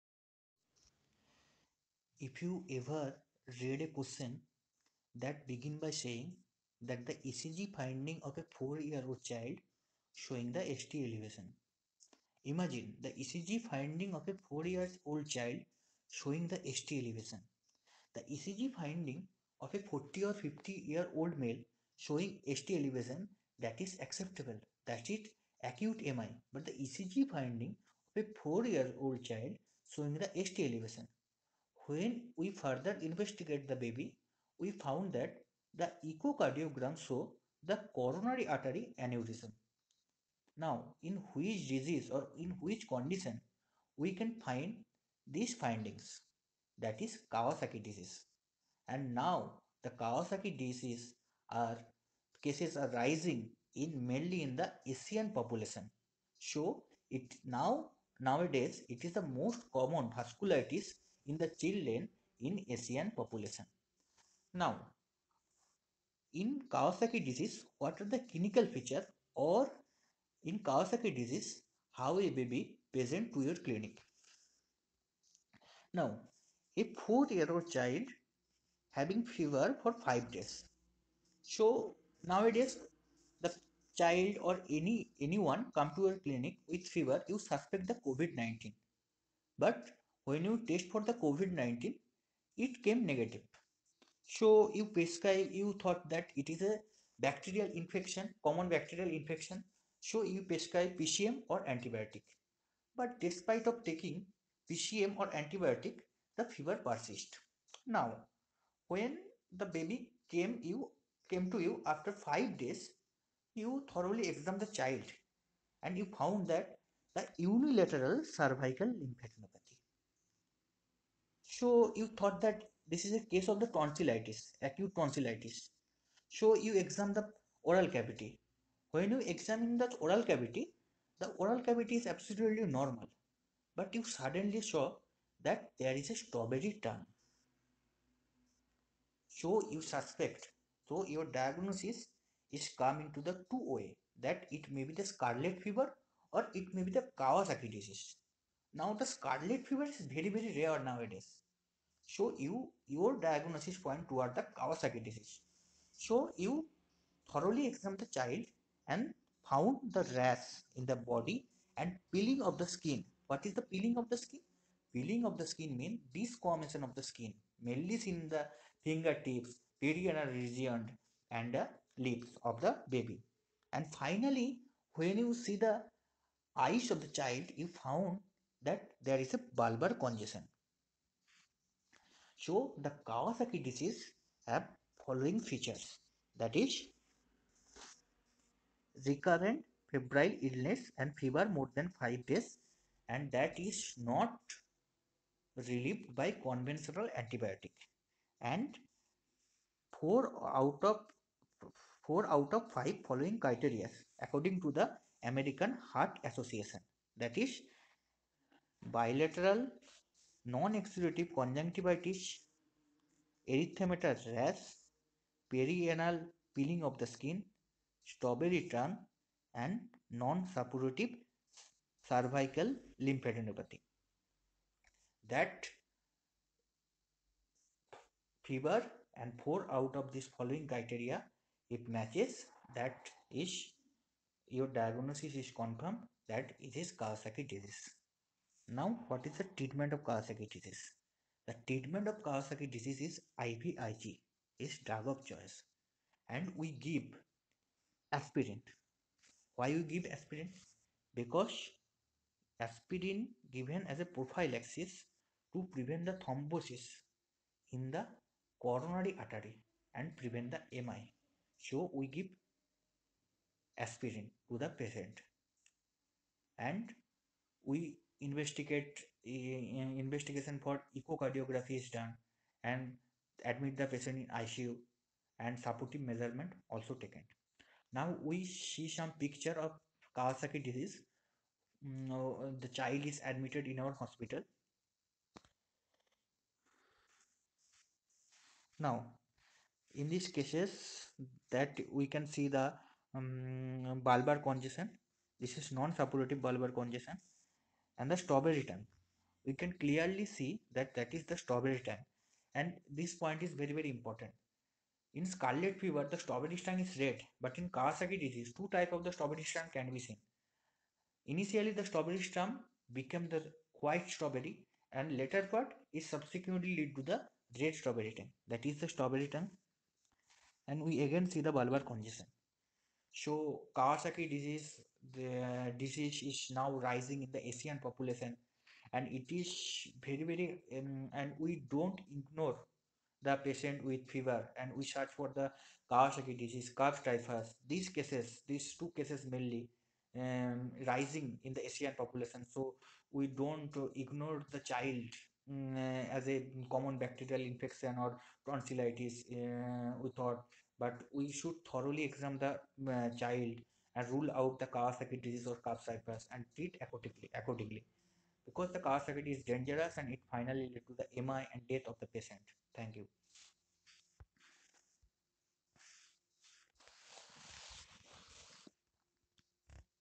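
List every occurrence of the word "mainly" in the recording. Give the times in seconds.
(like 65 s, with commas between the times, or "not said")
54 s, 167 s, 339 s.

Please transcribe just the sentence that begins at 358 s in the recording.
Because the Kawasaki is dangerous and it finally led to the MI and death of the patient.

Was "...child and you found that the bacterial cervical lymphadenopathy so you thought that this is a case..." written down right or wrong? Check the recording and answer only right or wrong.
wrong.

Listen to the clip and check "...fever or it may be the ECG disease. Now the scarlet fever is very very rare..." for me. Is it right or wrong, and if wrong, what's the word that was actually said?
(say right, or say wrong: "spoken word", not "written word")
wrong: "Kawasaki", not "ECG".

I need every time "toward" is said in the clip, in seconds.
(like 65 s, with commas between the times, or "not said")
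154 s.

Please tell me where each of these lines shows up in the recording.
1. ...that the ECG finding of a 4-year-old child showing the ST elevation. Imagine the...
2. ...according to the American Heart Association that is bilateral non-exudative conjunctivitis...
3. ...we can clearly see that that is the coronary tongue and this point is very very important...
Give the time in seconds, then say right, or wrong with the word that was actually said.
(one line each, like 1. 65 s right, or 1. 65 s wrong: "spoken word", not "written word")
1. 6 s right
2. 204 s right
3. 299 s wrong: "strawberry", not "coronary".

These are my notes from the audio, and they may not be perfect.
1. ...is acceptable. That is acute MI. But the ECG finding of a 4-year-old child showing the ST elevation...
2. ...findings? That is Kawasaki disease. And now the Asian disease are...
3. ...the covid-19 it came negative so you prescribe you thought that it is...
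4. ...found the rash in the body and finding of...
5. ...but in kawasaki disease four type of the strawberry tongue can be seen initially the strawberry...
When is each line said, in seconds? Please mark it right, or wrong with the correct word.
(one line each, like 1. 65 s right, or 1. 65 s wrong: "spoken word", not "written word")
1. 23 s right
2. 45 s wrong: "Kawasaki", not "Asian"
3. 91 s right
4. 159 s wrong: "peeling", not "finding"
5. 307 s wrong: "two", not "four".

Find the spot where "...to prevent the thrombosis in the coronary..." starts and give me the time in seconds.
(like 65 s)
255 s.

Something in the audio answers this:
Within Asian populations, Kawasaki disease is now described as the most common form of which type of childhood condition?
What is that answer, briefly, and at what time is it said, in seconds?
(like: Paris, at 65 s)
vasculitis, at 60 s.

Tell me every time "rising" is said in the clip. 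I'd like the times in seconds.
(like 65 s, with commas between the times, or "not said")
52 s, 326 s, 340 s.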